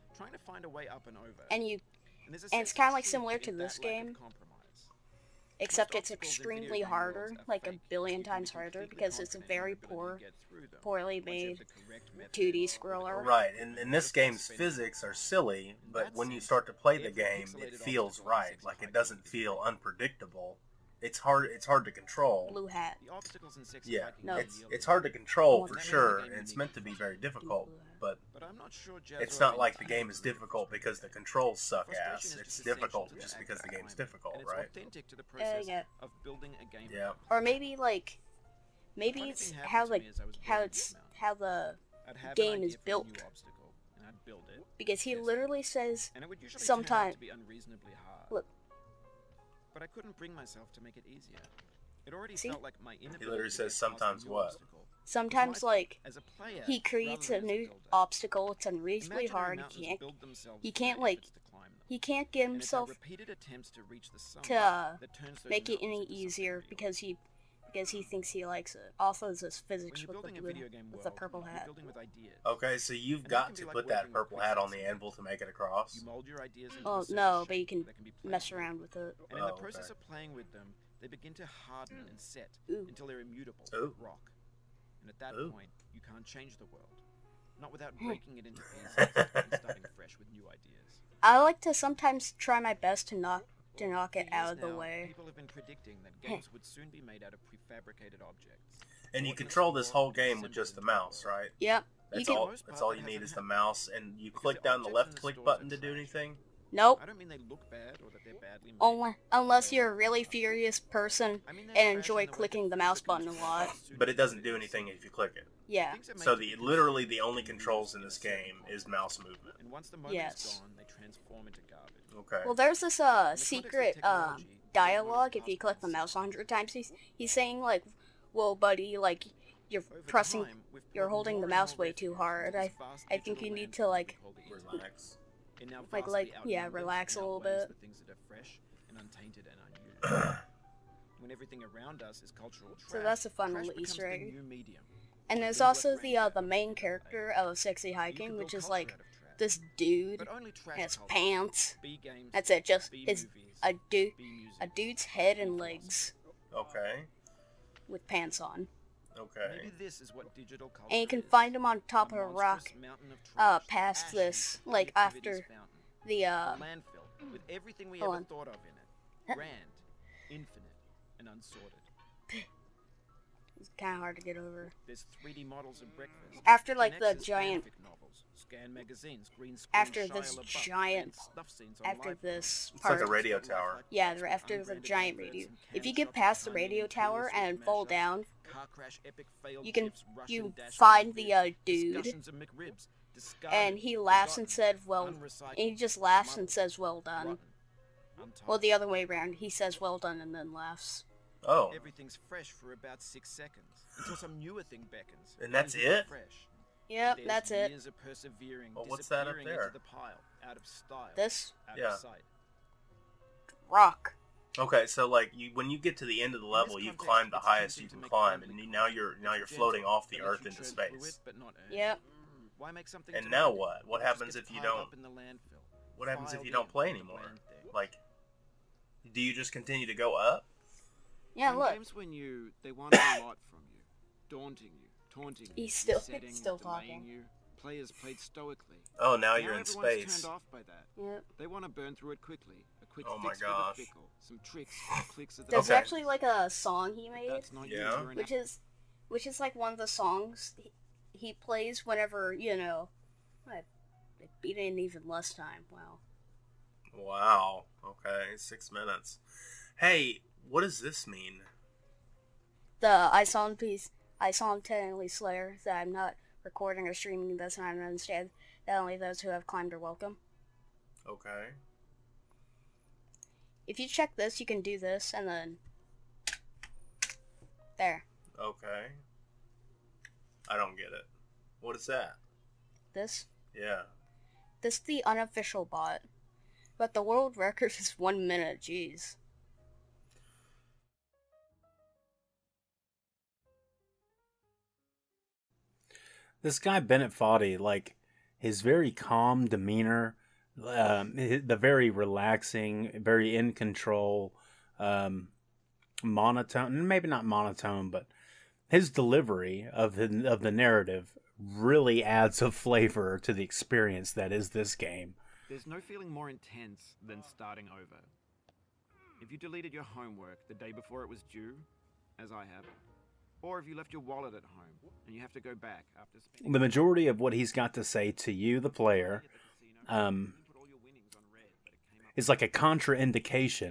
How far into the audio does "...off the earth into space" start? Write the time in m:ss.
3:39.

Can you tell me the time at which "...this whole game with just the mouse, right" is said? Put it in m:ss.
1:39.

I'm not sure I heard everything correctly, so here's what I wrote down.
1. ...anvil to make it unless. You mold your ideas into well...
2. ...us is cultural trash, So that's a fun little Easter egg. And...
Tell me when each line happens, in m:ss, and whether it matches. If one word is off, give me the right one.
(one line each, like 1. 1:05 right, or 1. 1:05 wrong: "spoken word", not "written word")
1. 1:14 wrong: "across", not "unless"
2. 2:22 right.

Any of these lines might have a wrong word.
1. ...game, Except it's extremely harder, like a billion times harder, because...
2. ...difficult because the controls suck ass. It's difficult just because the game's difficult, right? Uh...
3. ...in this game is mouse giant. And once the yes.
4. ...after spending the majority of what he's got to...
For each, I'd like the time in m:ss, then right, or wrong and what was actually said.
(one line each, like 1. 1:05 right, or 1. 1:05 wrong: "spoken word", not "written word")
1. 0:03 right
2. 0:30 right
3. 1:57 wrong: "movement", not "giant"
4. 5:25 right.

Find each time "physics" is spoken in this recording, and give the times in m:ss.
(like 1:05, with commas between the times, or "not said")
0:14, 1:09.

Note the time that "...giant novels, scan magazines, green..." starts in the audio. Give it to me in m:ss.
2:57.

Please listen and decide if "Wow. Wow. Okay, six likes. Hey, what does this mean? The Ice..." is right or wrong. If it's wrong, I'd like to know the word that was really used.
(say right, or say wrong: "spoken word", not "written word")
wrong: "minutes", not "likes".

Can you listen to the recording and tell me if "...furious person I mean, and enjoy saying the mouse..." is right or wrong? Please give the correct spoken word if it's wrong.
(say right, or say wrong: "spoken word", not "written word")
wrong: "clicking", not "saying".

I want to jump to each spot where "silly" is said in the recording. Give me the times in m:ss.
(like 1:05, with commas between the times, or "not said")
0:15.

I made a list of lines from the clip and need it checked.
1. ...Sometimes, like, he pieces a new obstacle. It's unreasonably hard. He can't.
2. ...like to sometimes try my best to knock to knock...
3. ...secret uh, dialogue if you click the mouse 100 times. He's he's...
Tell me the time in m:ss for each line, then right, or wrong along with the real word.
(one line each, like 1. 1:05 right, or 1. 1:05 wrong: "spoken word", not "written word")
1. 0:55 wrong: "creates", not "pieces"
2. 1:31 right
3. 2:03 right.